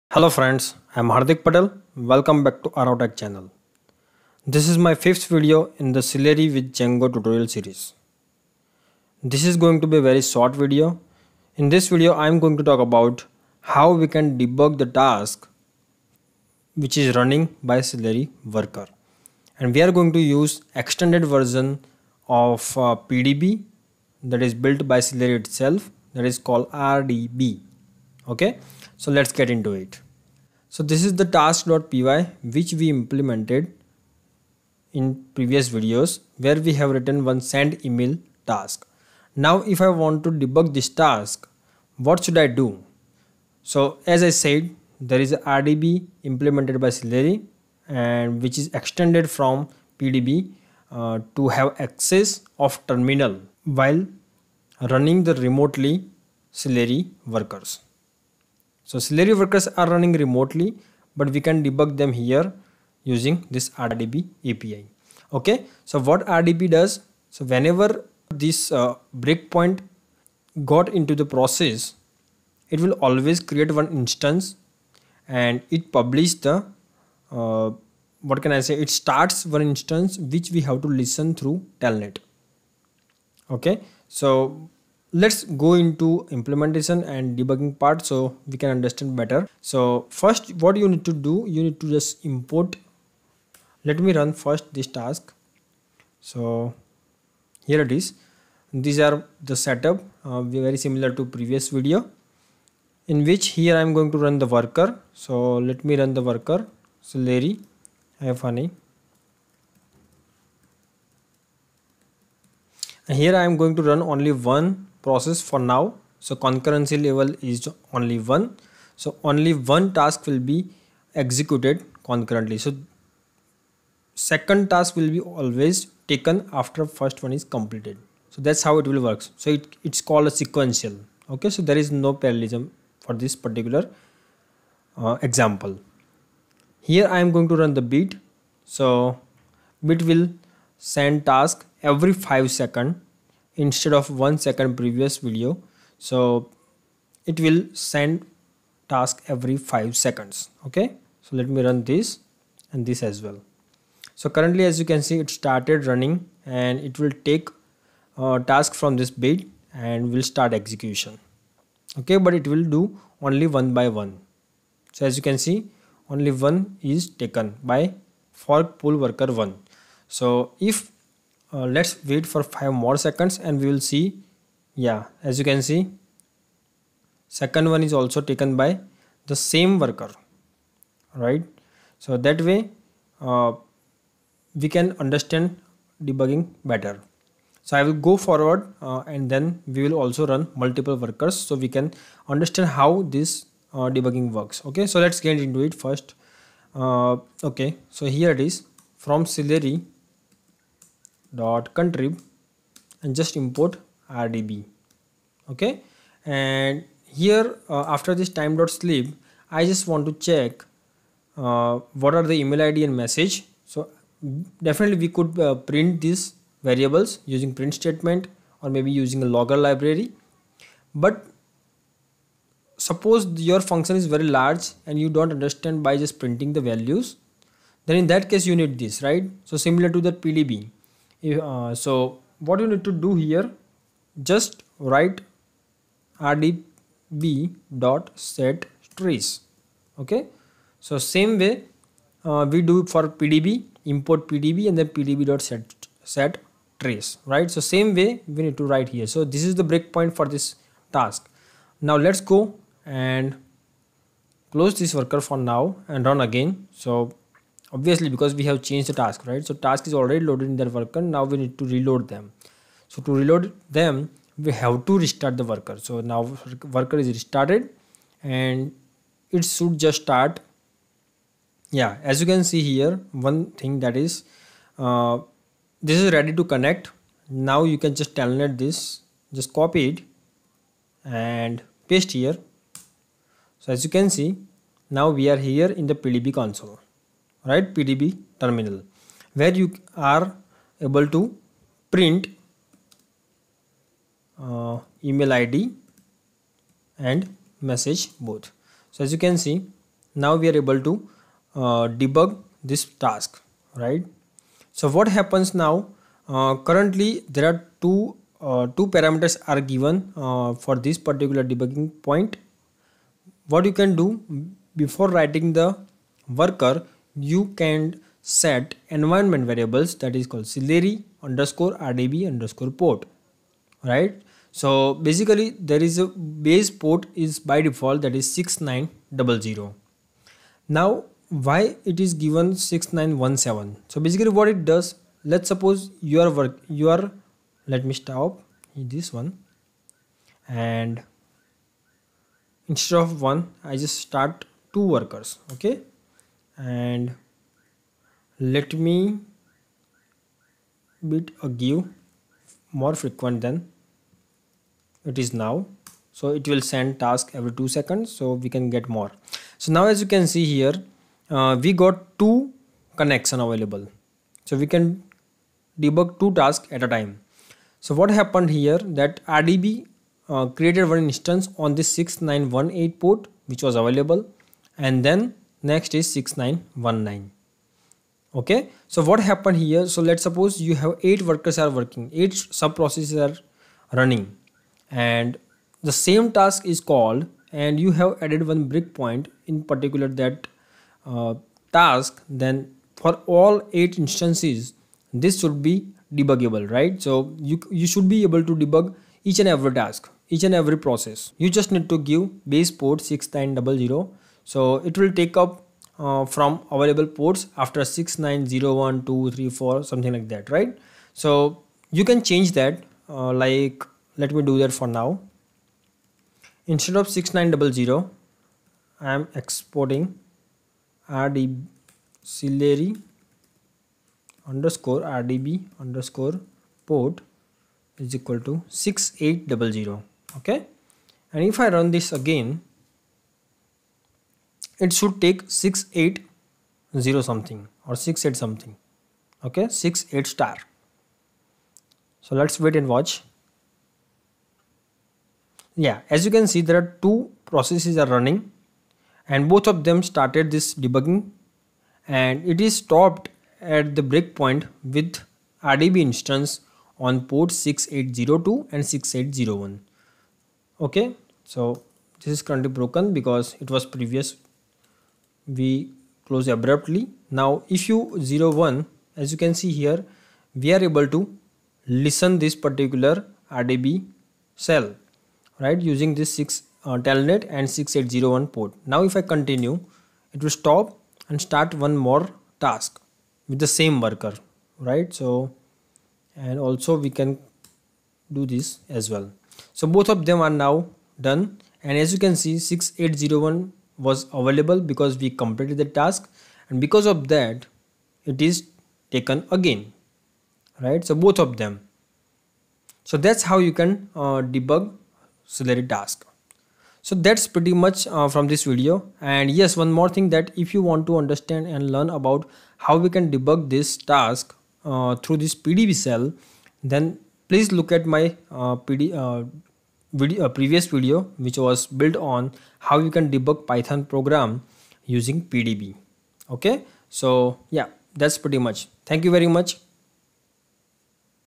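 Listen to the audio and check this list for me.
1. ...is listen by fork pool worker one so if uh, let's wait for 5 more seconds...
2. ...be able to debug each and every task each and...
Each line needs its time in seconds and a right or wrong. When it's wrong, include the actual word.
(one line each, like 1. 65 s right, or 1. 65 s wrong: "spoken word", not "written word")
1. 166 s wrong: "taken", not "listen"
2. 398 s right.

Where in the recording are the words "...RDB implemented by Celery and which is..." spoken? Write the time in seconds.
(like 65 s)
45 s.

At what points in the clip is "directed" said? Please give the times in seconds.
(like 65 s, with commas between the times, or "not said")
not said.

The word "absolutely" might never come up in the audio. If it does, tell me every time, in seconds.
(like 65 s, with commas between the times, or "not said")
not said.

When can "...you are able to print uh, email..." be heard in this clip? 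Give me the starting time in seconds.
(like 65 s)
289 s.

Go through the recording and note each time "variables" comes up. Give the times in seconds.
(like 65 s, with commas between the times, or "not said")
216 s, 319 s.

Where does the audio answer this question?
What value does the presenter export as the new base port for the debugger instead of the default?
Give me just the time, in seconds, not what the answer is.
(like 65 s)
428 s.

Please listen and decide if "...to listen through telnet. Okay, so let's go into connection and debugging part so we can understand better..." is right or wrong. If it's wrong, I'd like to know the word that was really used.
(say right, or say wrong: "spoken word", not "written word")
wrong: "implementation", not "connection".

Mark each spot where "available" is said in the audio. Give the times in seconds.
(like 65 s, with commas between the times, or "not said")
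363 s, 373 s, 406 s, 494 s.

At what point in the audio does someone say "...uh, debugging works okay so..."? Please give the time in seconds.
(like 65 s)
193 s.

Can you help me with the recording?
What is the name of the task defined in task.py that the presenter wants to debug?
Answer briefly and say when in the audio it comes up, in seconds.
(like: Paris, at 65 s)
send email, at 37 s.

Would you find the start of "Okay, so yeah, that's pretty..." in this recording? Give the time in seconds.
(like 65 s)
526 s.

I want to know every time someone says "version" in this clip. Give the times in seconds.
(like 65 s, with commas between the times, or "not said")
21 s.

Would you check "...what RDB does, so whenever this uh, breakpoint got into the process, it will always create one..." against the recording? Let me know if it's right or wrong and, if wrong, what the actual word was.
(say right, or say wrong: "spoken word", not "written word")
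right.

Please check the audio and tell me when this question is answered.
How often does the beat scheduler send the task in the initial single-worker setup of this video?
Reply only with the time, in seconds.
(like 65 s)
141 s.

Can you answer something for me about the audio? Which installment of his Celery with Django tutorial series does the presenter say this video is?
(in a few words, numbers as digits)
fifth.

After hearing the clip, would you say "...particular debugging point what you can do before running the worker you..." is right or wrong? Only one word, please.
wrong.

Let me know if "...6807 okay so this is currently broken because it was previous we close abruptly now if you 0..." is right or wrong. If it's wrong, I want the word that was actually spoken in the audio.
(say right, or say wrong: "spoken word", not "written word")
wrong: "6801", not "6807".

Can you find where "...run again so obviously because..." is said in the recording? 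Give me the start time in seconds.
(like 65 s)
256 s.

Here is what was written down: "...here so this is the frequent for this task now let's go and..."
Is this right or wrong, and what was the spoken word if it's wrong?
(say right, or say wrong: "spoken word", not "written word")
wrong: "breakpoint", not "frequent".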